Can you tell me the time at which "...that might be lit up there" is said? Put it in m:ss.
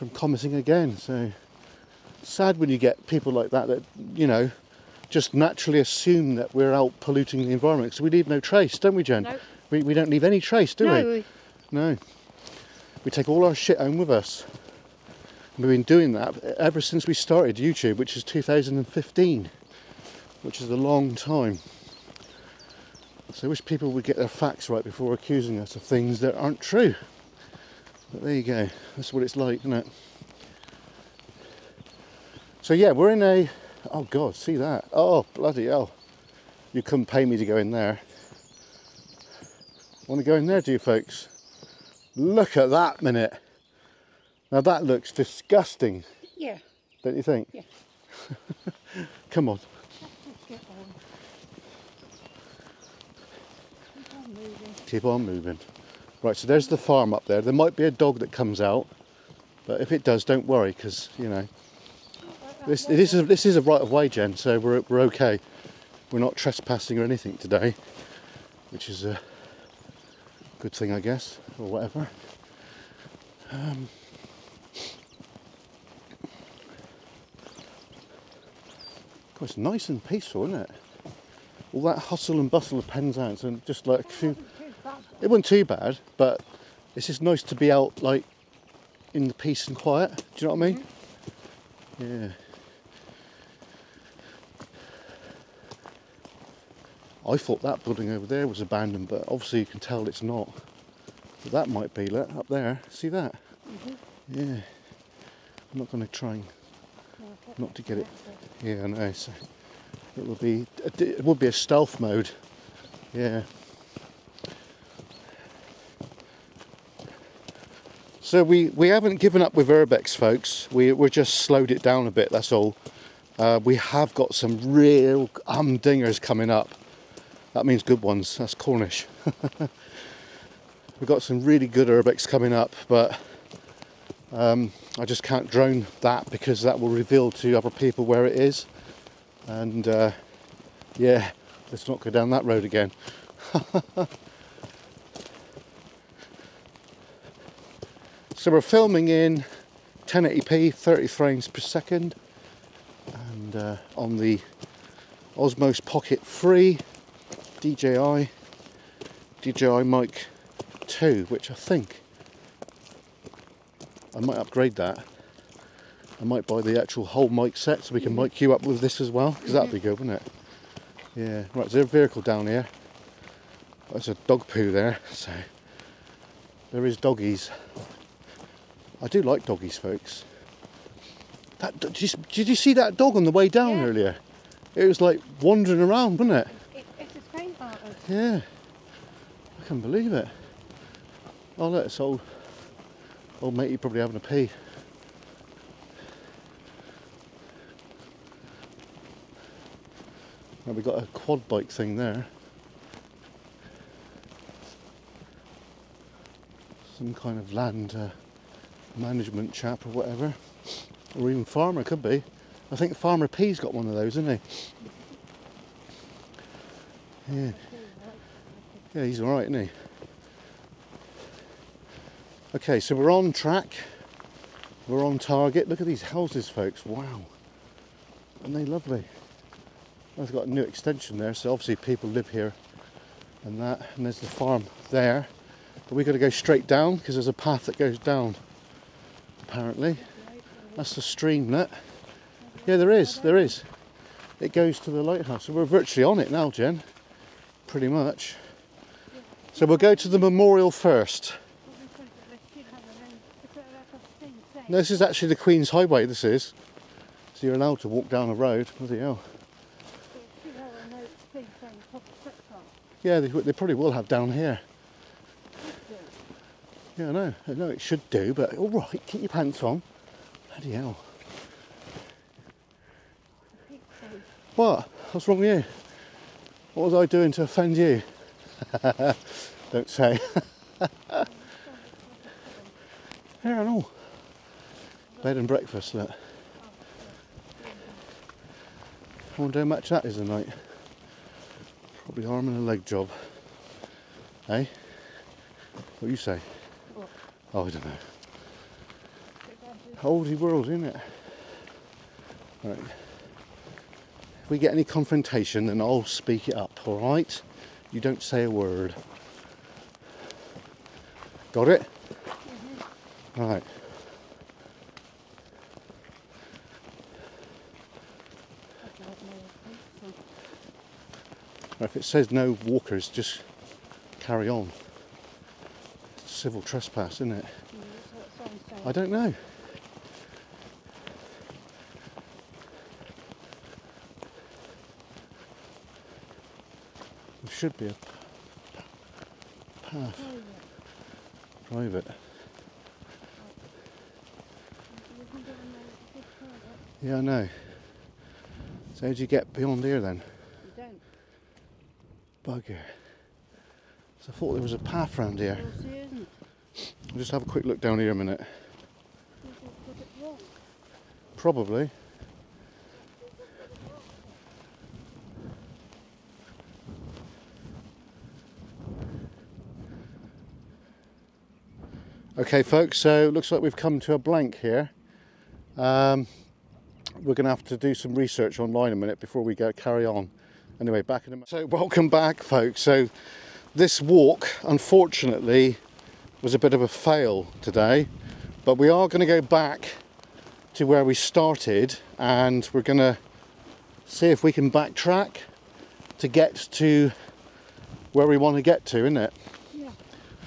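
1:41.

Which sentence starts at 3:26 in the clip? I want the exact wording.
Some kind of land uh, management chap or whatever.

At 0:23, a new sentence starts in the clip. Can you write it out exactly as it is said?
So I wish people would get their facts right before accusing us of things that aren't true.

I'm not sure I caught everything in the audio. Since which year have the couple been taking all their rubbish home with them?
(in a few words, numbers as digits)
2015.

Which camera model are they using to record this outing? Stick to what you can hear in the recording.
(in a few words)
Osmo Pocket 3.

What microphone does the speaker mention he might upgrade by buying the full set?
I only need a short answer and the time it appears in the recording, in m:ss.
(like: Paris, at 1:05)
DJI Mic 2, at 2:39.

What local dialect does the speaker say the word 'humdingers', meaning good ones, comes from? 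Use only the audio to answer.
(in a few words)
Cornish.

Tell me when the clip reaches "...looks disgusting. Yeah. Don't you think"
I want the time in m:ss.
0:44.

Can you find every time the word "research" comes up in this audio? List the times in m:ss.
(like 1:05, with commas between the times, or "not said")
6:18.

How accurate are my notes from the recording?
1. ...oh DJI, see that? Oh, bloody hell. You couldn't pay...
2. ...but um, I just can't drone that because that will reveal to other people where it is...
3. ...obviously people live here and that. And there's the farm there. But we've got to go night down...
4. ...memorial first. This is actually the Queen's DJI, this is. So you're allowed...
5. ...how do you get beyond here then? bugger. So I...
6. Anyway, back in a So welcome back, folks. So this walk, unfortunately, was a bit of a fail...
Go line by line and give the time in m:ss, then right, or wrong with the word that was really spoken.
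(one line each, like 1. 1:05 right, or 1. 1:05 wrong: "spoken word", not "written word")
1. 0:33 wrong: "God", not "DJI"
2. 2:12 right
3. 3:51 wrong: "straight", not "night"
4. 4:10 wrong: "Highway", not "DJI"
5. 5:49 right
6. 6:20 right.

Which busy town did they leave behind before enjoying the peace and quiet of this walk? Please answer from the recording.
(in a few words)
Penzance.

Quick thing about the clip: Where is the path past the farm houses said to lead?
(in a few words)
the lighthouse.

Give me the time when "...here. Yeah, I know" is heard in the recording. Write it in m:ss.
4:24.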